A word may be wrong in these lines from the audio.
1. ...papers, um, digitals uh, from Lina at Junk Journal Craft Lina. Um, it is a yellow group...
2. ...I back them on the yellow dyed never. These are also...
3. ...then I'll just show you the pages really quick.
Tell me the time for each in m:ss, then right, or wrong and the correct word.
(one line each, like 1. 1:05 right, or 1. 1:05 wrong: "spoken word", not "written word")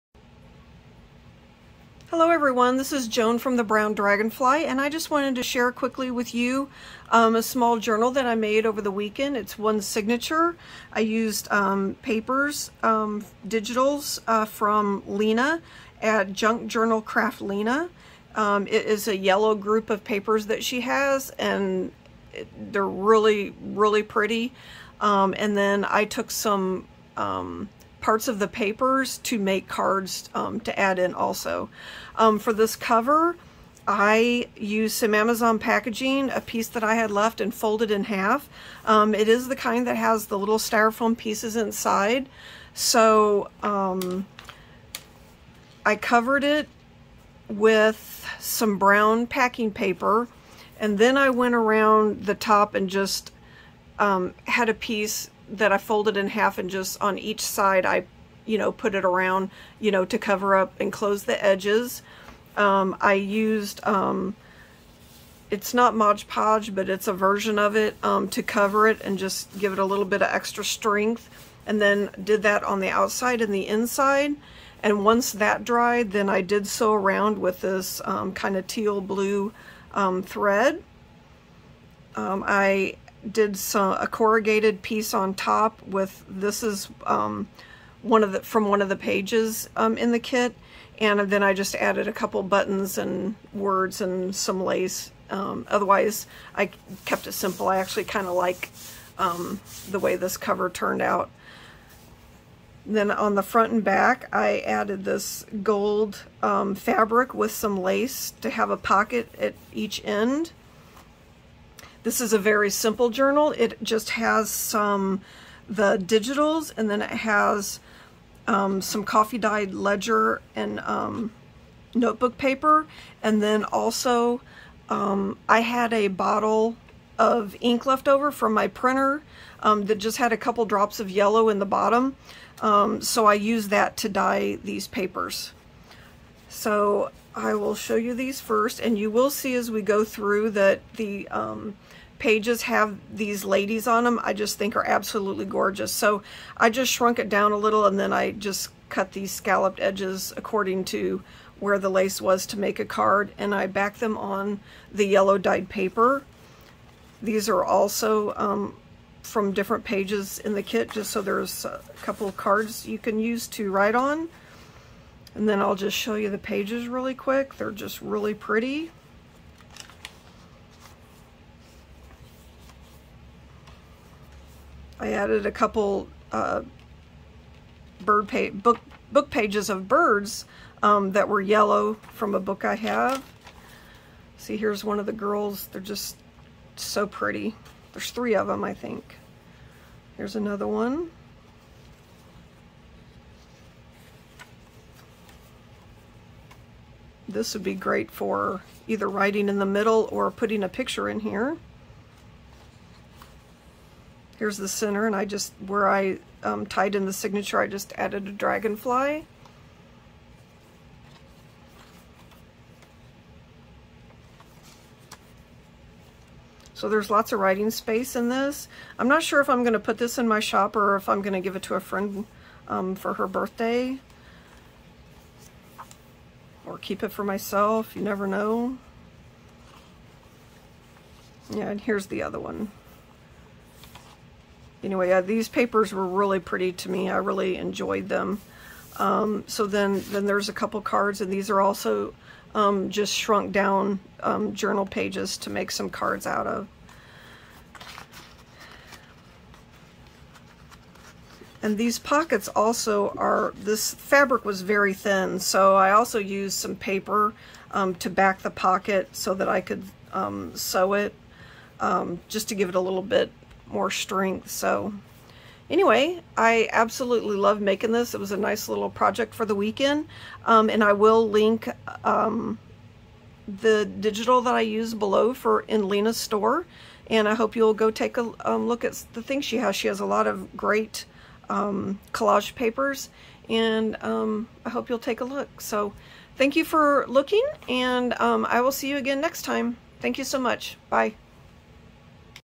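1. 0:12 right
2. 2:33 wrong: "paper", not "never"
3. 2:45 right.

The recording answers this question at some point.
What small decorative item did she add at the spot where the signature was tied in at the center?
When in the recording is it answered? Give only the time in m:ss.
3:28.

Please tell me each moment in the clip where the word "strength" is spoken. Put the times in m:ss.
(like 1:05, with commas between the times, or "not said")
1:10, 4:23.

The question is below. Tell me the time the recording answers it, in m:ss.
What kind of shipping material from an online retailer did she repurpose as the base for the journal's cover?
0:35.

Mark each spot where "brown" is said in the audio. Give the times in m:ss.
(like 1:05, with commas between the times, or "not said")
0:03, 0:48.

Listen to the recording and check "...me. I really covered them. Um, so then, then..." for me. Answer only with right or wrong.
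wrong.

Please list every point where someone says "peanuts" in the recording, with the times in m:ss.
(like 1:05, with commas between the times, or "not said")
not said.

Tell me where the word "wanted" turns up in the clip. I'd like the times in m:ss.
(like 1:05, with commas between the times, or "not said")
0:05.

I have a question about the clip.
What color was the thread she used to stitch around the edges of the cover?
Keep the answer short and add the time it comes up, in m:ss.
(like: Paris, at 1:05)
teal blue, at 1:18.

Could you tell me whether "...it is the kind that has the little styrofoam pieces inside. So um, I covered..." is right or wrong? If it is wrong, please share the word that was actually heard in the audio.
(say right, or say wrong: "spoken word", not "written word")
right.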